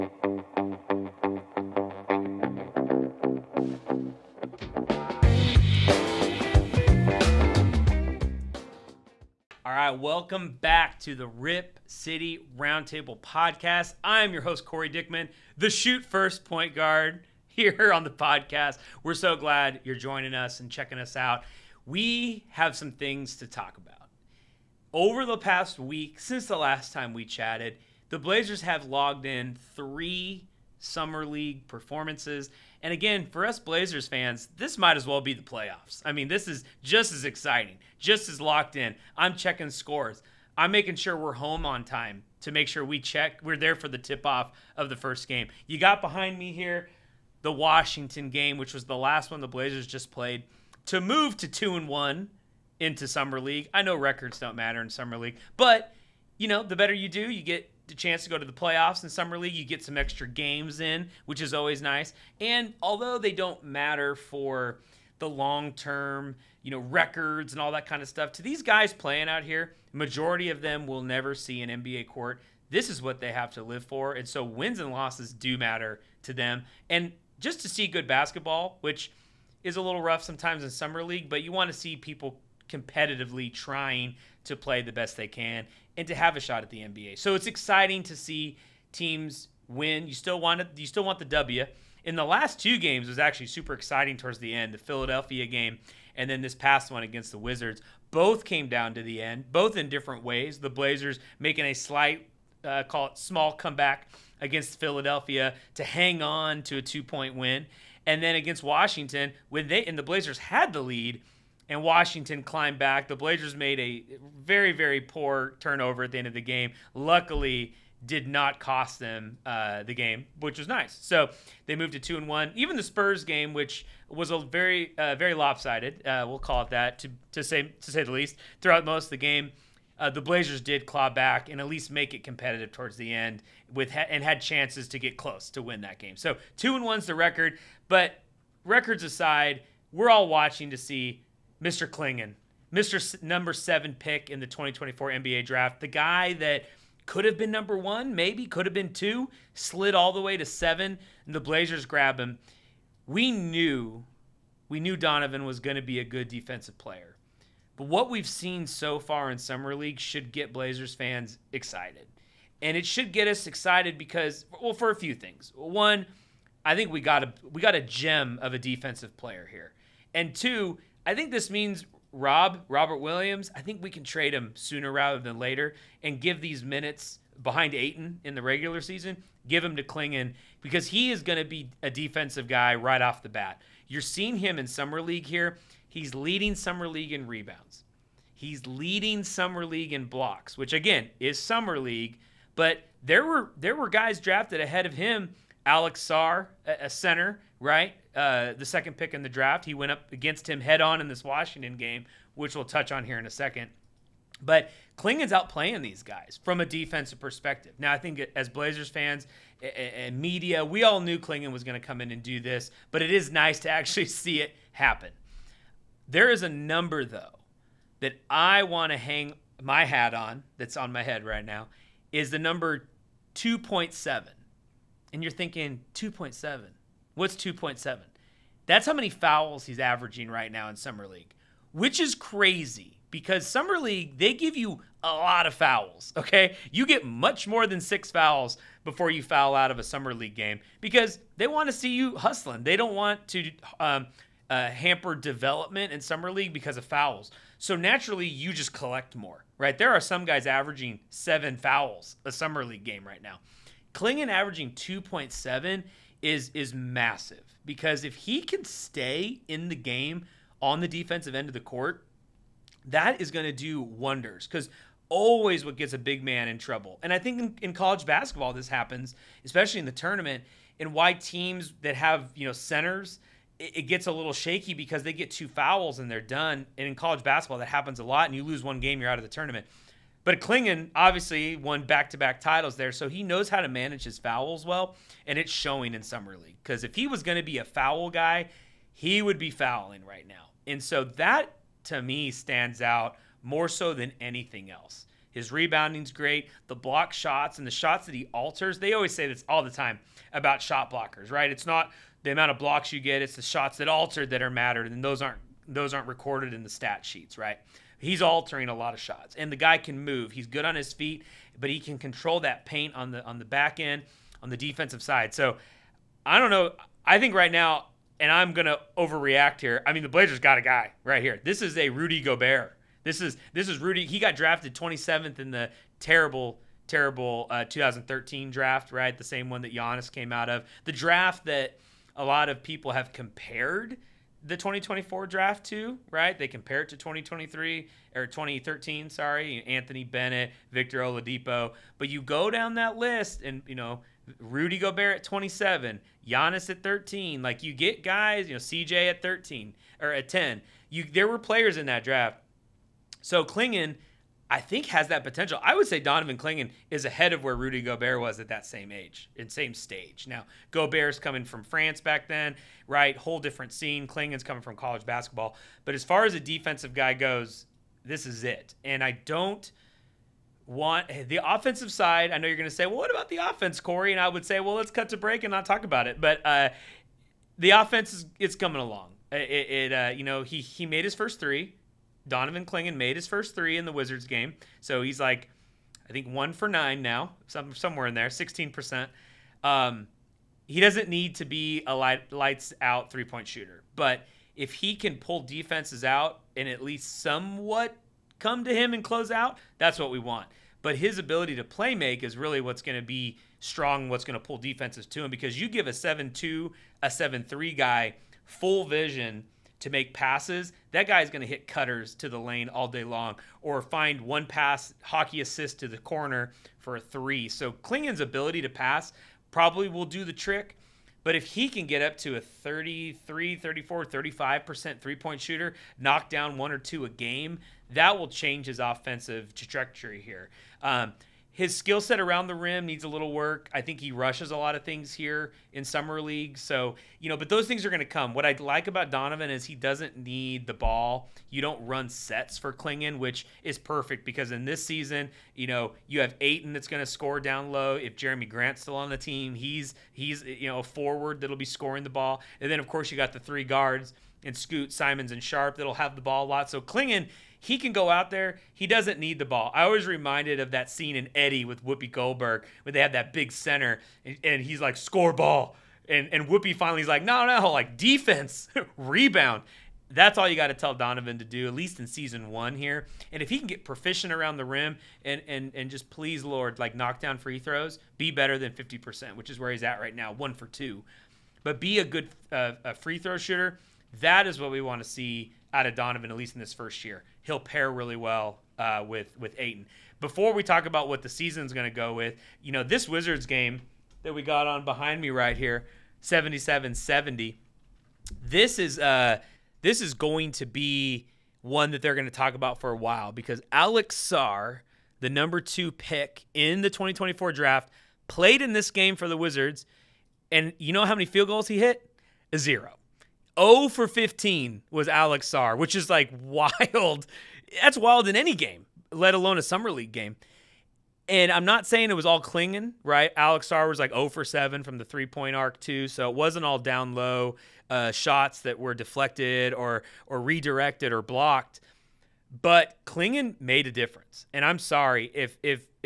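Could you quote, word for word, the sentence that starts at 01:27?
So it's exciting to see teams win.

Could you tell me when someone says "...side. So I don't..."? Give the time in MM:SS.
05:15.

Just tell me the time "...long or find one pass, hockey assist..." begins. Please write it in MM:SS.
06:53.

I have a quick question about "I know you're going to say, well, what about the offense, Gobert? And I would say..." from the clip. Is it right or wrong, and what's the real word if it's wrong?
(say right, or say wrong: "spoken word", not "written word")
wrong: "Corey", not "Gobert".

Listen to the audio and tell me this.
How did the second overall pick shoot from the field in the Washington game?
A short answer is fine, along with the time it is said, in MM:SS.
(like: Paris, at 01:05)
0 for 15, at 08:33.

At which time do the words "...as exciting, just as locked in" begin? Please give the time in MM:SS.
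00:37.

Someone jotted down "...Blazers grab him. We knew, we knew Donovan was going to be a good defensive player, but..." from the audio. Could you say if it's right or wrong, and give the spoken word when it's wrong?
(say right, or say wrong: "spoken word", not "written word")
right.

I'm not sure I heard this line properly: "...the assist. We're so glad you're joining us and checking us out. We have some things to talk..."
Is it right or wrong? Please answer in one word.
wrong.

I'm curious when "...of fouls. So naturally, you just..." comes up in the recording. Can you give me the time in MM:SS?
04:06.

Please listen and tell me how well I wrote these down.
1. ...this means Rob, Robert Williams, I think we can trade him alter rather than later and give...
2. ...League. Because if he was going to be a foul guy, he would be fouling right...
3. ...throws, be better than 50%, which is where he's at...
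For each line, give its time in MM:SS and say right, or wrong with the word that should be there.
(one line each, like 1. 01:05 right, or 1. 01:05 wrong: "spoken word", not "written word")
1. 02:51 wrong: "sooner", not "alter"
2. 04:46 right
3. 07:57 right.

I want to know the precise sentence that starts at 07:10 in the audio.
Um, his skill set around the rim needs a little work.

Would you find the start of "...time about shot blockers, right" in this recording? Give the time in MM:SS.
04:59.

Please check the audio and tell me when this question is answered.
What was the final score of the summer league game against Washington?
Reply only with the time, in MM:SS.
08:16.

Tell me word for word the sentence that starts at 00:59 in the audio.
You get some extra games in, which is always nice.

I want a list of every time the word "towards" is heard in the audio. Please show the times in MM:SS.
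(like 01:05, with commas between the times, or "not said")
01:34, 02:12.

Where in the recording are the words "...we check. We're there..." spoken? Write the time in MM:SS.
00:42.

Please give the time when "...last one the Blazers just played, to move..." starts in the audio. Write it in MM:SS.
00:48.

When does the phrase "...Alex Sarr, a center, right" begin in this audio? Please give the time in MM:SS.
03:15.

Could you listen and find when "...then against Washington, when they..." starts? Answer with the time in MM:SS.
01:48.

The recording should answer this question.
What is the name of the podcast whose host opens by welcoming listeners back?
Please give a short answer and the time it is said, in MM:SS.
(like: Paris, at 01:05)
Rip City Roundtable, at 00:11.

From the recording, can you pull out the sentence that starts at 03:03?
You're seeing him in Summer League here.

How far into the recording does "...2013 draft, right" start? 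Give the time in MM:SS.
05:27.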